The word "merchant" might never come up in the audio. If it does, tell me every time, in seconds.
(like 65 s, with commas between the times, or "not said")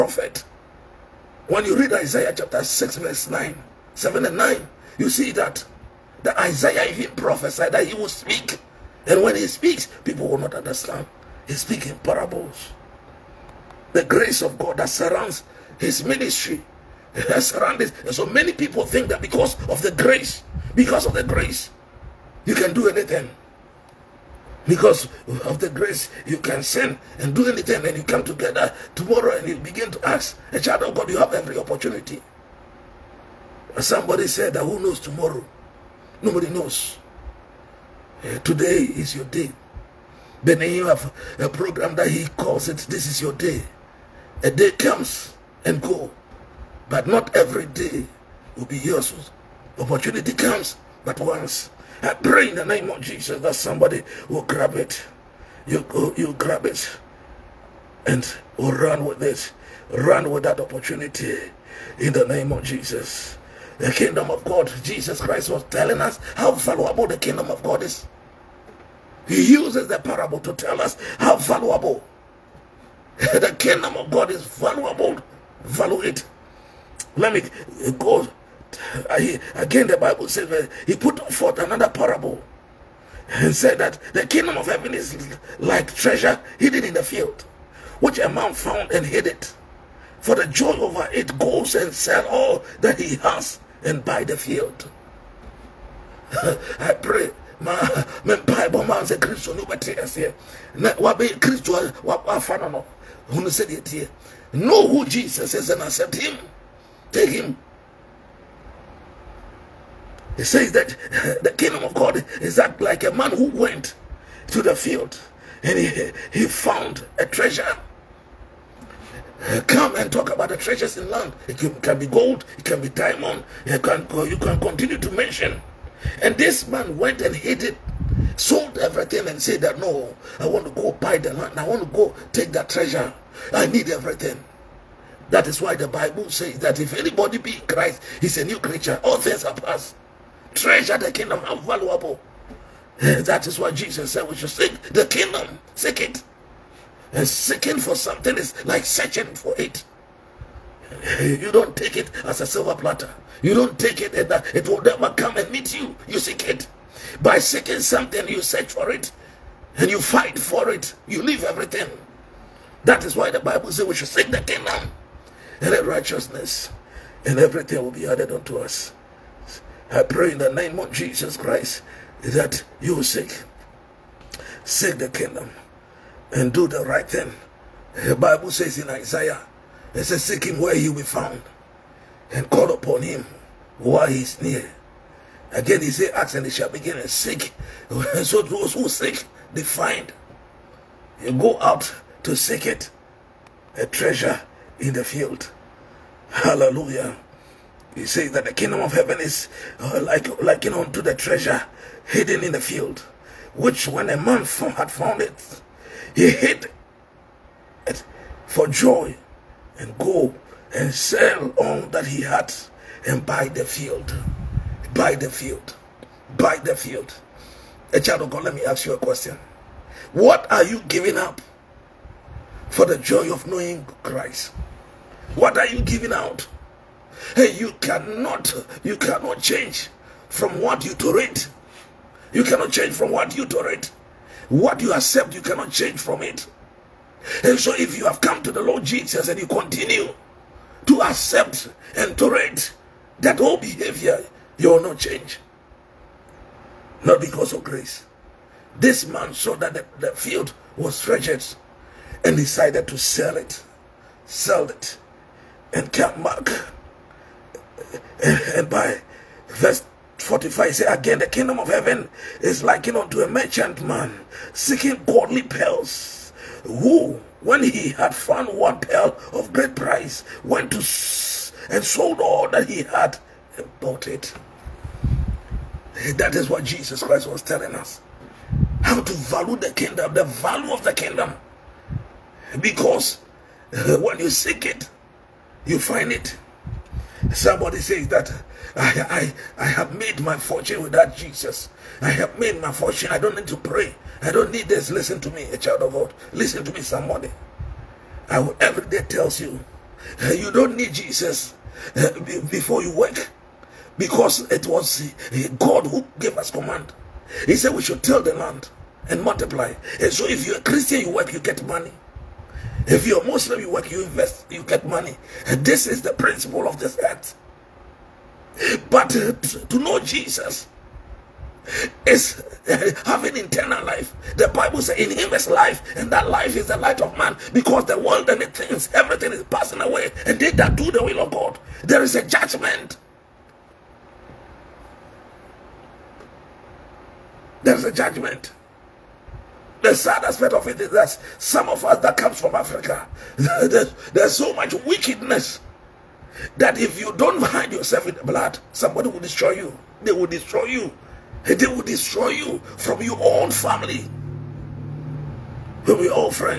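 263 s.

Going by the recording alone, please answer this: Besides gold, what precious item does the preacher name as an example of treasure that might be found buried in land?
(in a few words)
Diamond.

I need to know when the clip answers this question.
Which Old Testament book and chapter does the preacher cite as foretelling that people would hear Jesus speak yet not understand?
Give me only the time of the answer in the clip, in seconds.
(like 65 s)
1 s.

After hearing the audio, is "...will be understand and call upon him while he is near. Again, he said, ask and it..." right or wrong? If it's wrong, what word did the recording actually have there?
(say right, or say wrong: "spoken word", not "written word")
wrong: "found", not "understand".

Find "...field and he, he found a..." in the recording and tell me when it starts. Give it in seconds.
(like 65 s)
114 s.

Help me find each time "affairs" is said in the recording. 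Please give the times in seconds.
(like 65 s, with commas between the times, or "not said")
not said.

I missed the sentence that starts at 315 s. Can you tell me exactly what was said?
This is the principle of this earth.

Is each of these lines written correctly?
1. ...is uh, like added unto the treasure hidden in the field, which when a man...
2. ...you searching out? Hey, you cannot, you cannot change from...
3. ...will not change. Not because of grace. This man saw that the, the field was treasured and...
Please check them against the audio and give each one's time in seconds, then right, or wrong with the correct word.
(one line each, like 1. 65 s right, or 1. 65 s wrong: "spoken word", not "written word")
1. 199 s wrong: "likened", not "added"
2. 225 s wrong: "giving", not "searching"
3. 244 s right.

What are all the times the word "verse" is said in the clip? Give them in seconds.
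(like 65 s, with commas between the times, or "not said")
2 s, 259 s.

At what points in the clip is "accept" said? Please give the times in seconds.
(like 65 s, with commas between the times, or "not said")
105 s, 234 s, 241 s.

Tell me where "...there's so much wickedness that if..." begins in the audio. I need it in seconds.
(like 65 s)
344 s.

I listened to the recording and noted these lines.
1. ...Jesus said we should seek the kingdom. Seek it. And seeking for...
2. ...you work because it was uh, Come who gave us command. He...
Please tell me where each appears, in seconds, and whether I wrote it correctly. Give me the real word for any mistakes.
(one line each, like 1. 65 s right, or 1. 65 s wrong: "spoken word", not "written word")
1. 143 s right
2. 302 s wrong: "God", not "Come".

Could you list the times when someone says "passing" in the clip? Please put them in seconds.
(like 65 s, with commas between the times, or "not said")
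329 s.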